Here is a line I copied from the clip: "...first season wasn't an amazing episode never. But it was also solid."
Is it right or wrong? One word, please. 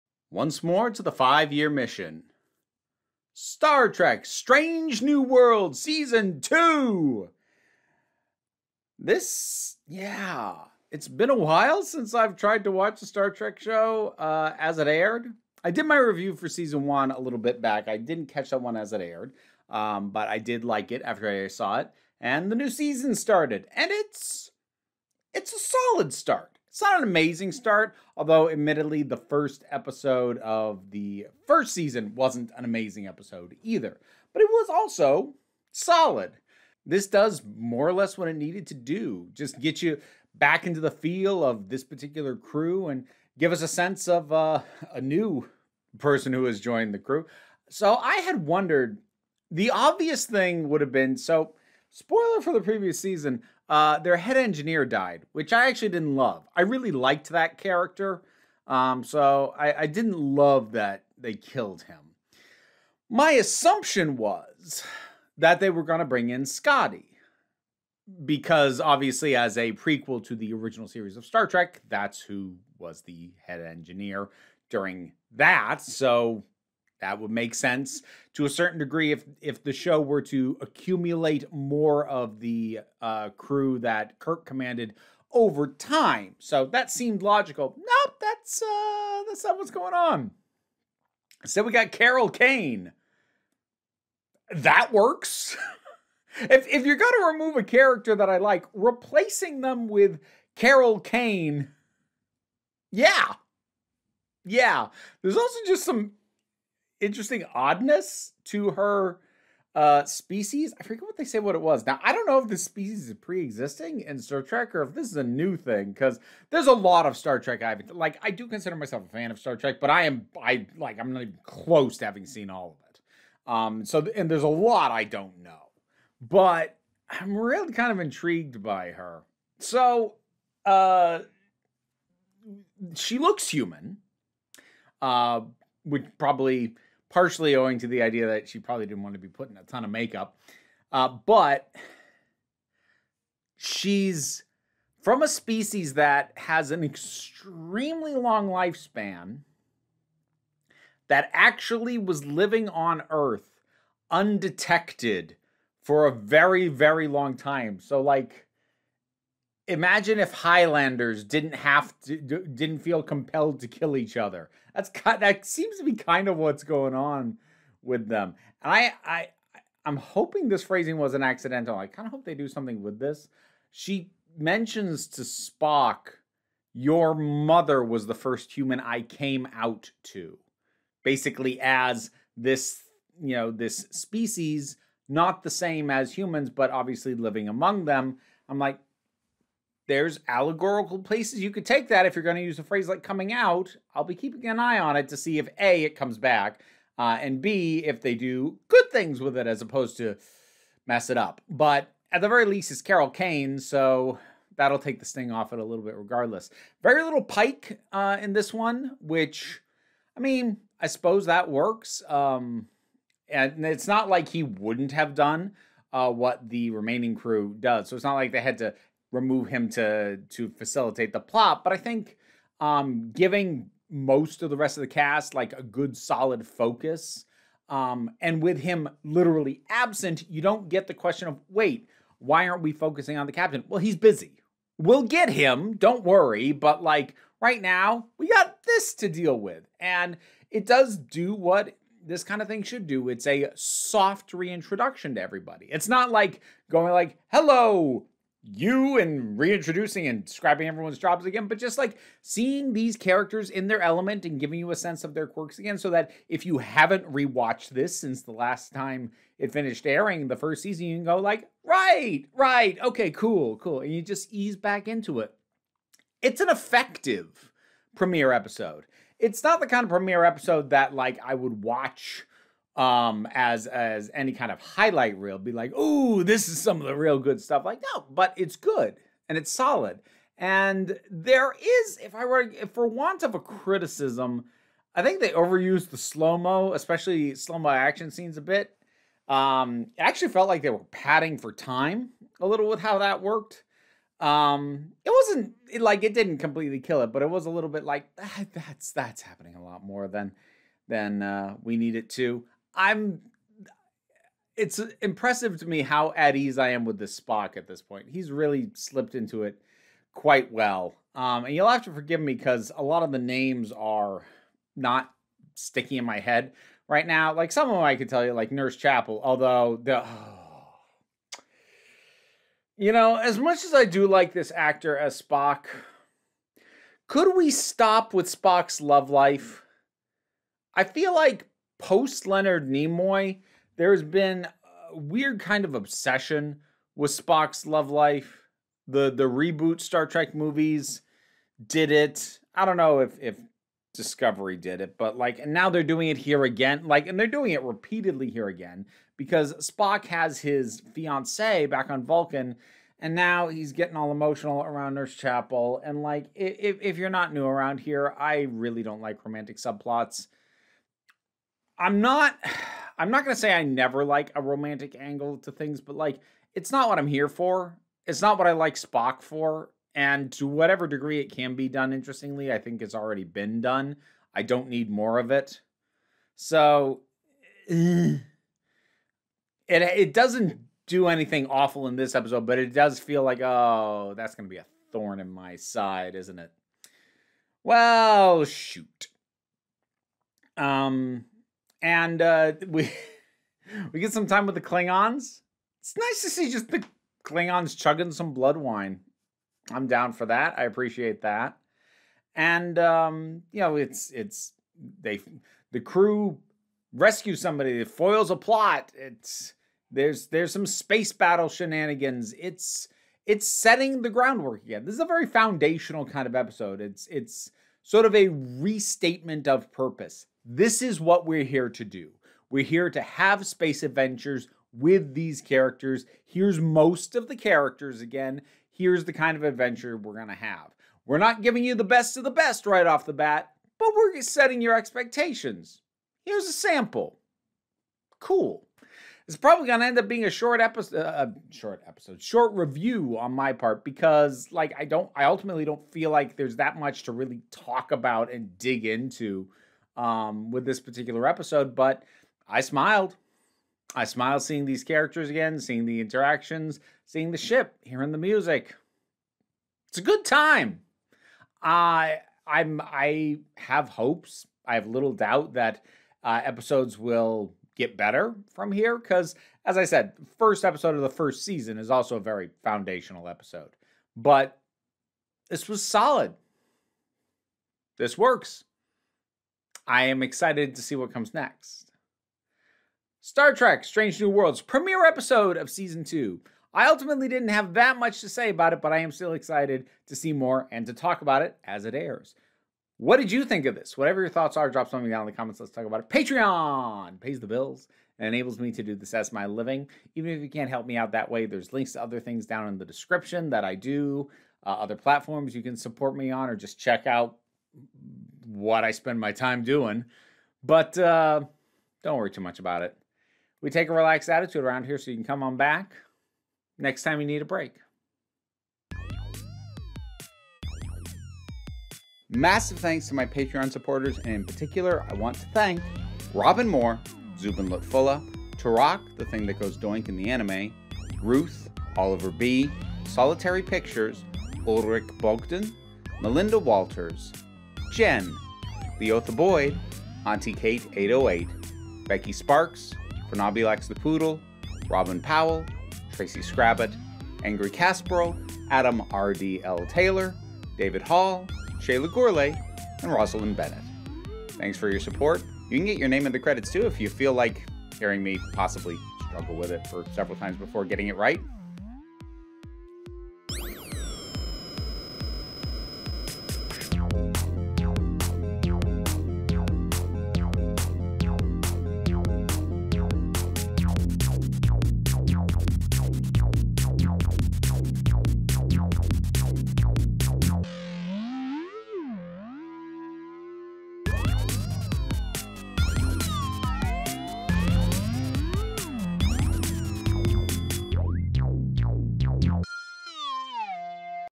wrong.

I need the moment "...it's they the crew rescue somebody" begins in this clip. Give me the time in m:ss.
6:44.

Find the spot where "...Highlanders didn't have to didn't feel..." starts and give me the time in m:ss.
2:40.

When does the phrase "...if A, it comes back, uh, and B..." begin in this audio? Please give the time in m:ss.
3:15.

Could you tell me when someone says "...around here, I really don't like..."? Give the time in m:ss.
5:57.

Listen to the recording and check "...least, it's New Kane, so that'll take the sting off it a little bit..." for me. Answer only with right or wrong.
wrong.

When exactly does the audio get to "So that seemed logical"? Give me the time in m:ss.
1:26.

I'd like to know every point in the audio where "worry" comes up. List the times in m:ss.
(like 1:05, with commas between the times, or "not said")
3:56, 8:32.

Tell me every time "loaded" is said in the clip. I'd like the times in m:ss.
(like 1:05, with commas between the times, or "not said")
not said.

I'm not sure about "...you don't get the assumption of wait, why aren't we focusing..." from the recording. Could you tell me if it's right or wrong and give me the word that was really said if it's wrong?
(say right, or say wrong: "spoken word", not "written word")
wrong: "question", not "assumption".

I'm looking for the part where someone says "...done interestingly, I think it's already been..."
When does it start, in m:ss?
6:11.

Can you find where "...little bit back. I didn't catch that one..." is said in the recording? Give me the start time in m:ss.
0:17.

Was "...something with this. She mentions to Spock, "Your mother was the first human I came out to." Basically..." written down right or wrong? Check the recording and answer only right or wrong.
right.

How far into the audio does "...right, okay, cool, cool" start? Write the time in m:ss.
4:22.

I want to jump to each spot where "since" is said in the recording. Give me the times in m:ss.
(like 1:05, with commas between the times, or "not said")
0:11, 4:17.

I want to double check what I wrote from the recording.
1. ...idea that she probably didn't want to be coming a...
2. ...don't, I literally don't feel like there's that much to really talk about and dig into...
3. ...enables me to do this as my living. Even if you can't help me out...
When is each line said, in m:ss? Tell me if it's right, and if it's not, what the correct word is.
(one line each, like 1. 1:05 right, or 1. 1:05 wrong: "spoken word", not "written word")
1. 2:18 wrong: "putting", not "coming"
2. 7:24 wrong: "ultimately", not "literally"
3. 8:18 right.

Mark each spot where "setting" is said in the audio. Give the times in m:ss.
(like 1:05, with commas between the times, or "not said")
6:53, 7:14.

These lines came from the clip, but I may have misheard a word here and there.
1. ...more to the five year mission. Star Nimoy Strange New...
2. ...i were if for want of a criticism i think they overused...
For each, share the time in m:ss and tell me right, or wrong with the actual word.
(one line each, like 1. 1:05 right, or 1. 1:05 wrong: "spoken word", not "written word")
1. 0:00 wrong: "Trek", not "Nimoy"
2. 4:42 right.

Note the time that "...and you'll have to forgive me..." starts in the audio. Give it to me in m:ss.
5:11.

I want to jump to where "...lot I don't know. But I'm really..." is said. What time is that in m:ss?
2:04.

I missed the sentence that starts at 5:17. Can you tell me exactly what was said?
Like some of them I could tell you, like Nurse Chapel, although the.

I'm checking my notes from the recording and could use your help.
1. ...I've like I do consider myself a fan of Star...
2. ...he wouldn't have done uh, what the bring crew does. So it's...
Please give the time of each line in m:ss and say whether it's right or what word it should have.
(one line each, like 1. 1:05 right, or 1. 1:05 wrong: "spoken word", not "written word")
1. 1:57 right
2. 3:34 wrong: "remaining", not "bring".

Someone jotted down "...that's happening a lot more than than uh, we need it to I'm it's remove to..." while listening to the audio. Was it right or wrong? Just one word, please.
wrong.